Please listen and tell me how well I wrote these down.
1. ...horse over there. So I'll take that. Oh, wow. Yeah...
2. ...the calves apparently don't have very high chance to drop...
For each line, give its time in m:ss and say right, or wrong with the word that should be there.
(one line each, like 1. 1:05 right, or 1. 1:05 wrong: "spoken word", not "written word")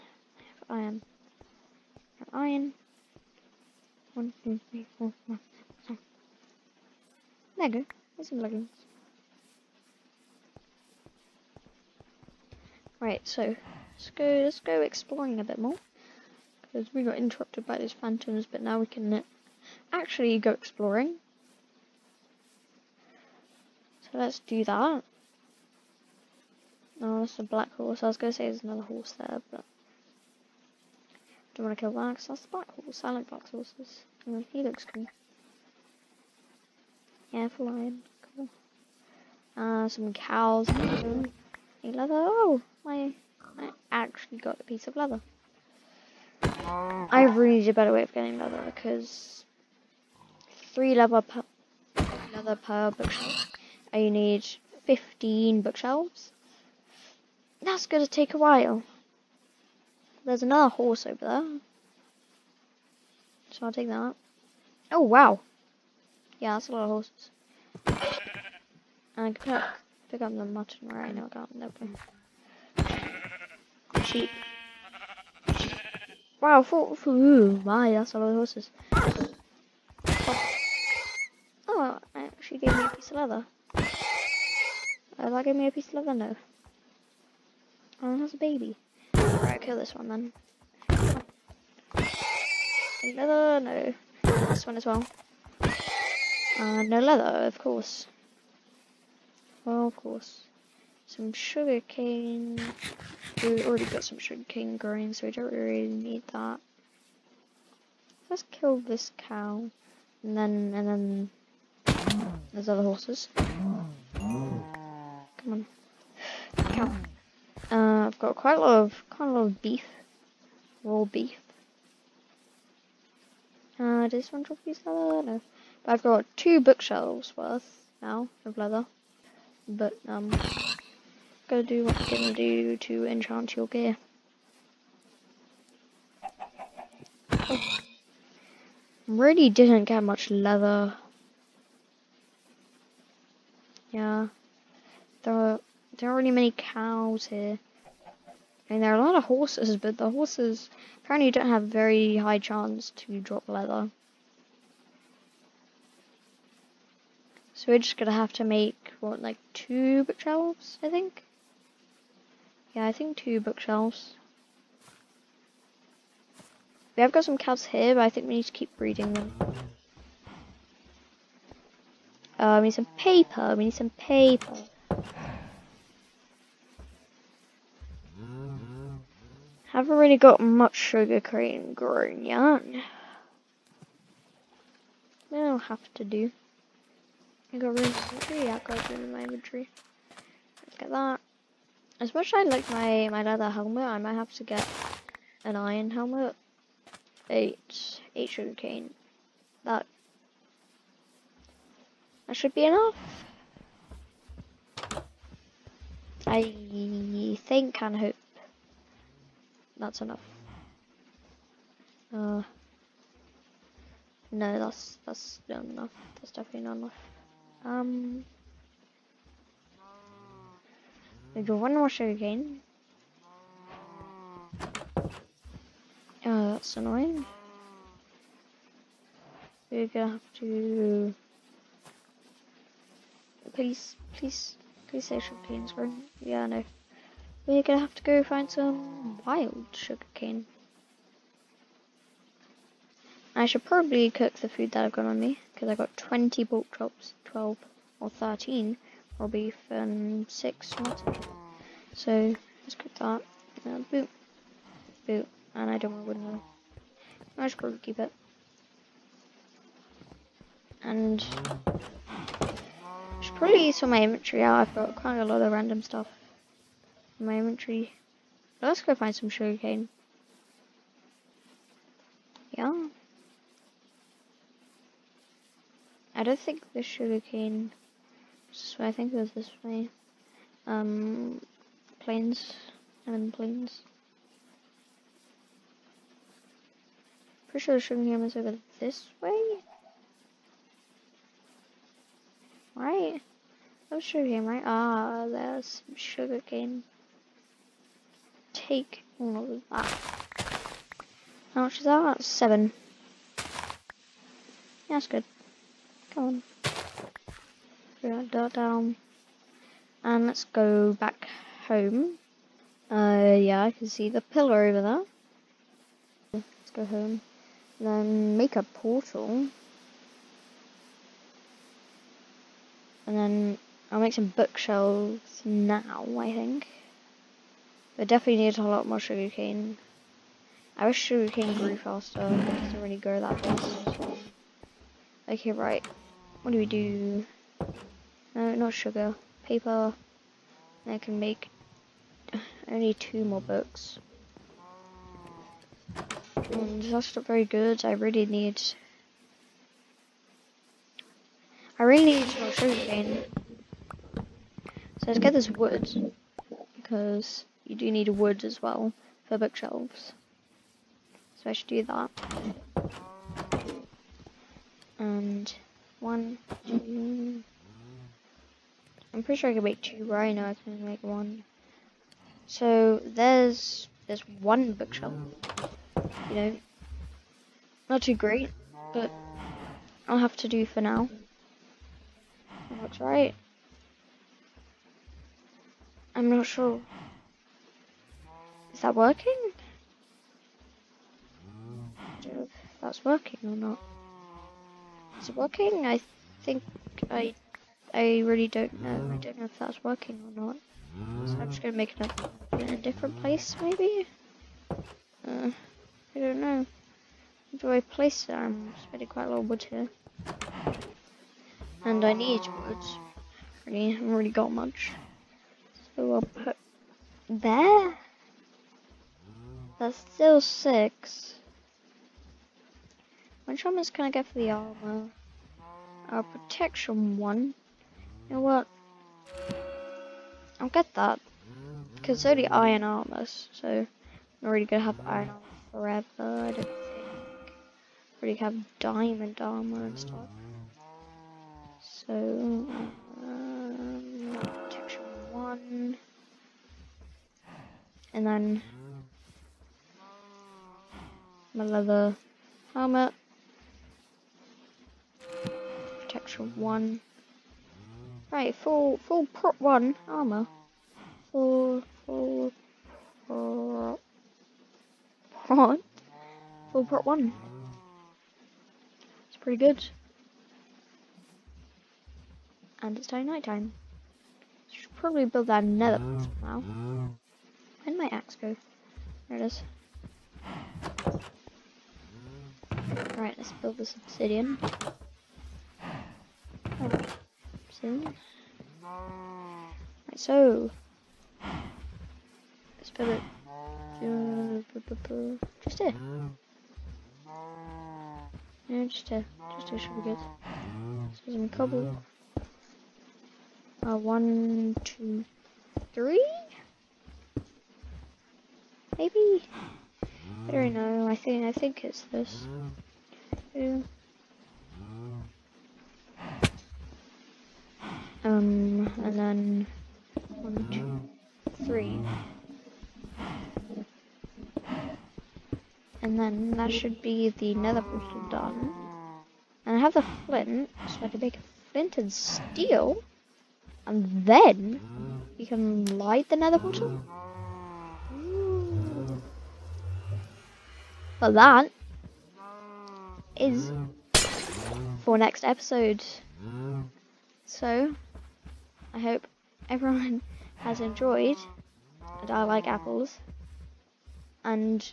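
1. 1:00 right
2. 2:29 wrong: "horses", not "calves".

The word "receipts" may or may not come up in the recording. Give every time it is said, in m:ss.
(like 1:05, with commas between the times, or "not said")
not said.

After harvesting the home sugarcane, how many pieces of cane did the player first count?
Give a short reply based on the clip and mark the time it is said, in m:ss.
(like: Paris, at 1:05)
8, at 3:18.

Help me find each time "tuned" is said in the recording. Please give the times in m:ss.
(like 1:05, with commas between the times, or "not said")
not said.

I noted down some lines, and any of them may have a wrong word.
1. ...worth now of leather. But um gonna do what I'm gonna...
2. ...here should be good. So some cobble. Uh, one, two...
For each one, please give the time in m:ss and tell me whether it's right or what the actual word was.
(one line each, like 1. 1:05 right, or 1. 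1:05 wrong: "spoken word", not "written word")
1. 2:07 right
2. 8:19 right.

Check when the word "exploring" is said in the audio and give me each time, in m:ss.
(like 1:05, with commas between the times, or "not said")
0:14, 0:20.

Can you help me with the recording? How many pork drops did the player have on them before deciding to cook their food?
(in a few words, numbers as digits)
20.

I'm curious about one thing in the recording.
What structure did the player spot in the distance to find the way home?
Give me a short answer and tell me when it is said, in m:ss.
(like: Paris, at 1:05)
The pillar, at 5:14.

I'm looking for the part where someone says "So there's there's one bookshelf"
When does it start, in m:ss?
6:12.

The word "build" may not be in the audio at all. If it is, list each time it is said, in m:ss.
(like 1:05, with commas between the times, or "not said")
7:55, 8:03, 8:12.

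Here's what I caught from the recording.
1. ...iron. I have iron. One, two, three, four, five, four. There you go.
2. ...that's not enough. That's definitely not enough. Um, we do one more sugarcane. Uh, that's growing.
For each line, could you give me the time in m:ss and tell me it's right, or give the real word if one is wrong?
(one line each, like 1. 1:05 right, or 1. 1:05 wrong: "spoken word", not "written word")
1. 0:00 wrong: "six", not "four"
2. 3:35 wrong: "annoying", not "growing".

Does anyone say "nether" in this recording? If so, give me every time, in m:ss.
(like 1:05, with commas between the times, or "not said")
7:55, 8:47, 8:56.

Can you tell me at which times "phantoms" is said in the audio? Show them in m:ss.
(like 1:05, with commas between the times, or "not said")
0:17.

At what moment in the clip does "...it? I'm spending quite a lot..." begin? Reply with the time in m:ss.
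6:48.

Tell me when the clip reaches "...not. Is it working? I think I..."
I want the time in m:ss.
6:33.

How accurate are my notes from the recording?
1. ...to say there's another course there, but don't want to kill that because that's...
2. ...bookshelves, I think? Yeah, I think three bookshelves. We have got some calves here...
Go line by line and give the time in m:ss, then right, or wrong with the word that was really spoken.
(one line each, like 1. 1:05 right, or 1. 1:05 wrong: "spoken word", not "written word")
1. 0:28 wrong: "horse", not "course"
2. 2:40 wrong: "two", not "three".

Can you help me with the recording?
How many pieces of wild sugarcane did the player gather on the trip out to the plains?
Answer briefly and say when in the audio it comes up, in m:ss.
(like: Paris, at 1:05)
7, at 5:02.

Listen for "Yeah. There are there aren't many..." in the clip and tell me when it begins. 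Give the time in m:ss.
2:23.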